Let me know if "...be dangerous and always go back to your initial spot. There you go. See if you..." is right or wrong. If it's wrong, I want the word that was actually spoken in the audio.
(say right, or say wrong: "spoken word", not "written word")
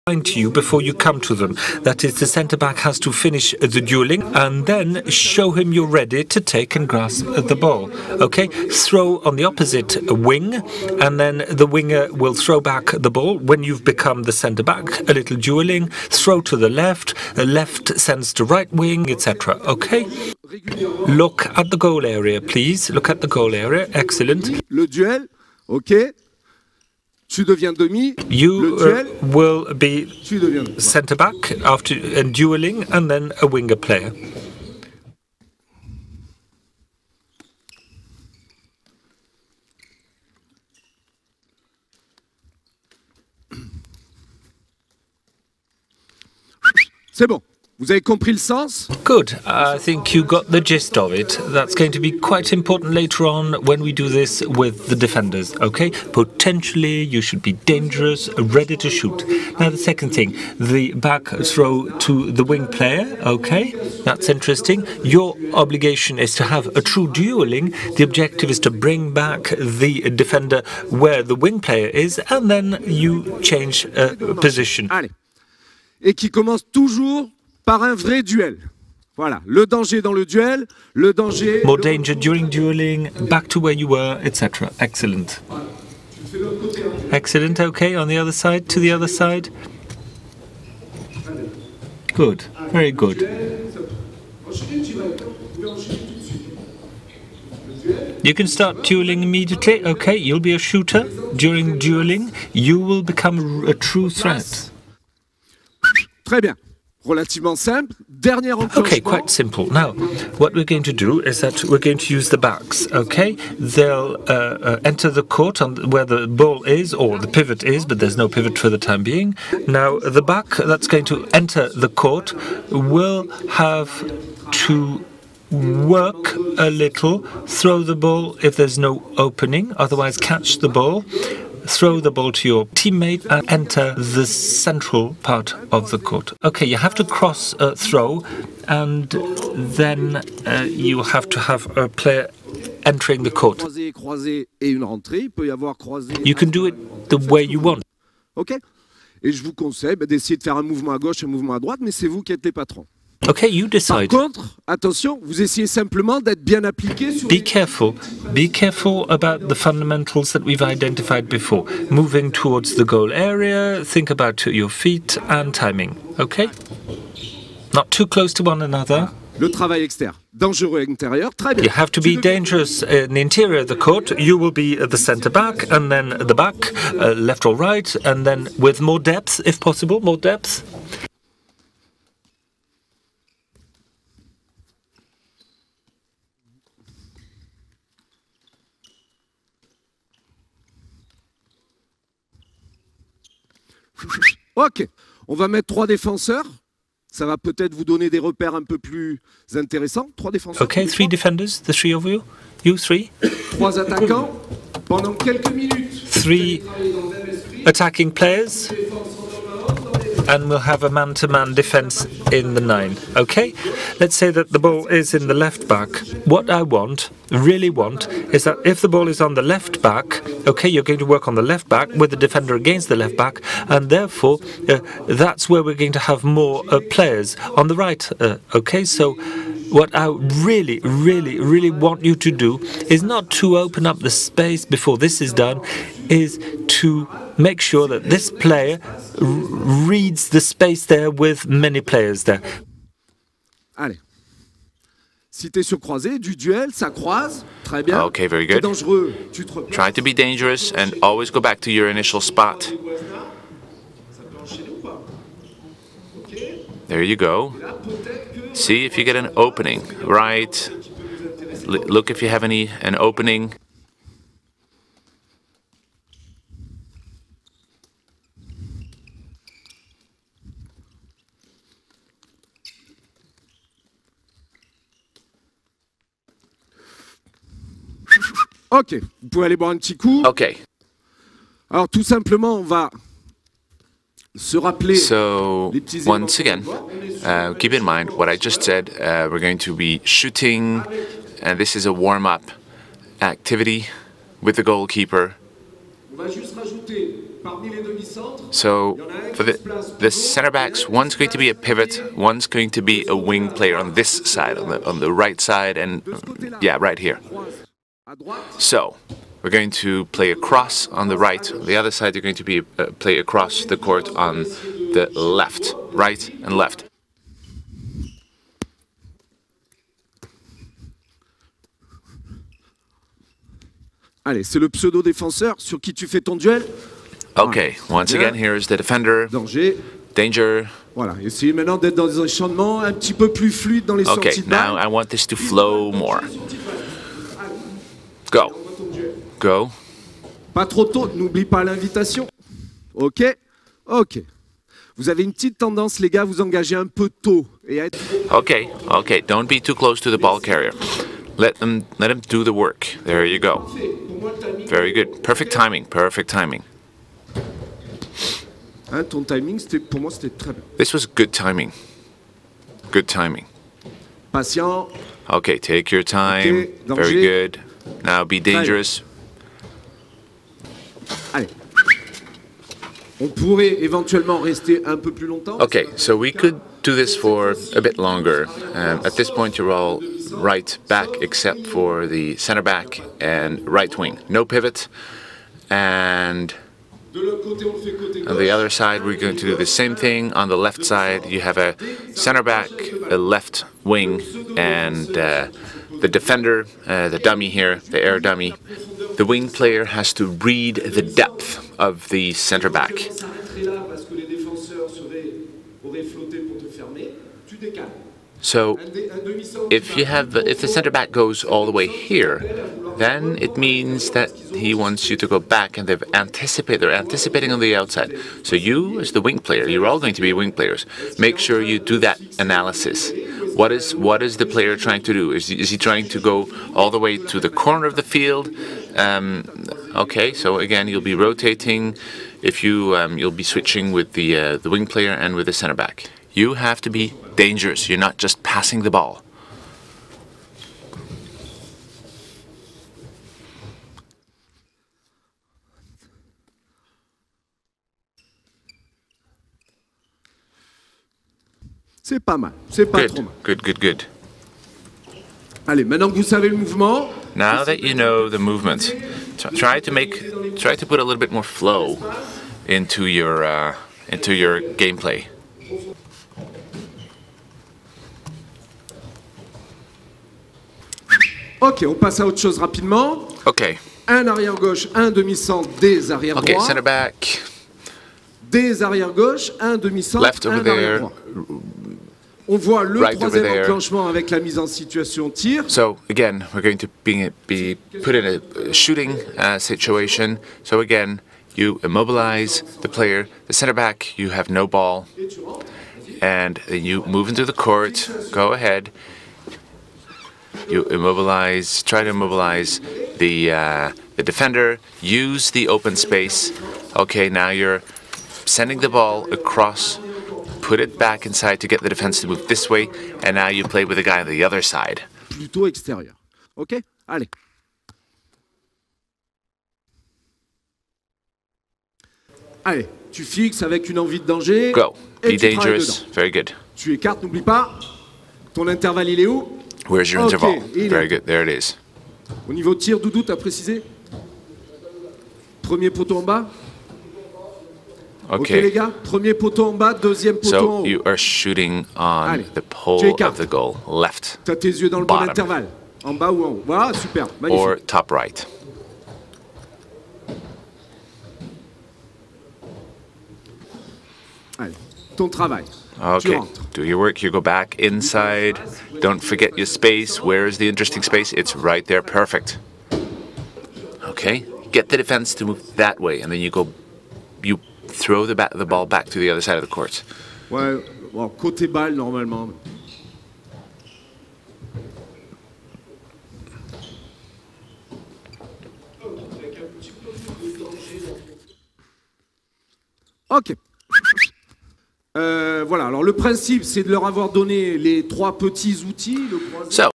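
right.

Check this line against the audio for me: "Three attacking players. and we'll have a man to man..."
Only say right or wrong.
right.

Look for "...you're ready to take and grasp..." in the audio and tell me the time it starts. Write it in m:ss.
0:05.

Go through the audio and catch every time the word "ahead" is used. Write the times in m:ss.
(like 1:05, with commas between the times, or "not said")
8:18.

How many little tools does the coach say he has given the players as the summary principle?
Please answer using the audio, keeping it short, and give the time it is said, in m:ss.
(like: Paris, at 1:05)
3, at 9:48.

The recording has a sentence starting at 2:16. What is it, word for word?
Okay, you have to cross a throw, and then uh, you have to have a player entering the court.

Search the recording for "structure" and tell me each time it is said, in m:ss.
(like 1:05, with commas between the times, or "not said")
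not said.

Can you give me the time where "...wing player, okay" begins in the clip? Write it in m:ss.
1:02.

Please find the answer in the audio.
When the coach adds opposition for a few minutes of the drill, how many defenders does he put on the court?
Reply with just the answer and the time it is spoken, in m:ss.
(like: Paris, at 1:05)
3, at 3:20.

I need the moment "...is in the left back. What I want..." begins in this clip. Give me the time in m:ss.
3:34.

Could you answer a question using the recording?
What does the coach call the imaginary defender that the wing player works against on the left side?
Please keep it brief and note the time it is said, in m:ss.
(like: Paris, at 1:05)
Air dummy, at 6:37.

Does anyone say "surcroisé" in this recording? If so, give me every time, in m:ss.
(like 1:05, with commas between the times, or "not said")
4:05.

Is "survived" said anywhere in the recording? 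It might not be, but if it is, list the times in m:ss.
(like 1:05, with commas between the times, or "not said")
not said.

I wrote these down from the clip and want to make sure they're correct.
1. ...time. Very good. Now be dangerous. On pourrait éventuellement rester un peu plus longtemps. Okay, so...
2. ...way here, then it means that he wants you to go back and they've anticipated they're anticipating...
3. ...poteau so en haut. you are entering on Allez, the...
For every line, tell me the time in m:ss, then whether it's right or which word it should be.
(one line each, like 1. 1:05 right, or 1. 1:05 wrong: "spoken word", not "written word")
1. 6:06 right
2. 6:51 right
3. 9:00 wrong: "shooting", not "entering".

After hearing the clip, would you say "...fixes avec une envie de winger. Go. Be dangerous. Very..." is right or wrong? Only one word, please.
wrong.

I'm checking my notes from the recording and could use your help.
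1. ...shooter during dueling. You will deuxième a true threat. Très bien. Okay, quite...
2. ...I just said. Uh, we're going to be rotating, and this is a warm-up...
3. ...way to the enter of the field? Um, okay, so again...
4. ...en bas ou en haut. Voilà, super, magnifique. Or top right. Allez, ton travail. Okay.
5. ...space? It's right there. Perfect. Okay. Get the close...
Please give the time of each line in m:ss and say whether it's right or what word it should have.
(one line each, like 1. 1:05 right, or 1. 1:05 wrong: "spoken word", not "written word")
1. 1:40 wrong: "become", not "deuxième"
2. 4:48 wrong: "shooting", not "rotating"
3. 7:06 wrong: "corner", not "enter"
4. 9:06 right
5. 9:21 wrong: "defense", not "close".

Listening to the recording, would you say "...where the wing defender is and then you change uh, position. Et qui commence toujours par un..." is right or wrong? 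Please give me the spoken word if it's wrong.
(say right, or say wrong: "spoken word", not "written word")
wrong: "player", not "defender".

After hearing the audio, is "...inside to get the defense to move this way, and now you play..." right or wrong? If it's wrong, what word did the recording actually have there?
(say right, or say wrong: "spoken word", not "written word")
right.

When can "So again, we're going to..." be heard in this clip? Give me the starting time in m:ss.
8:05.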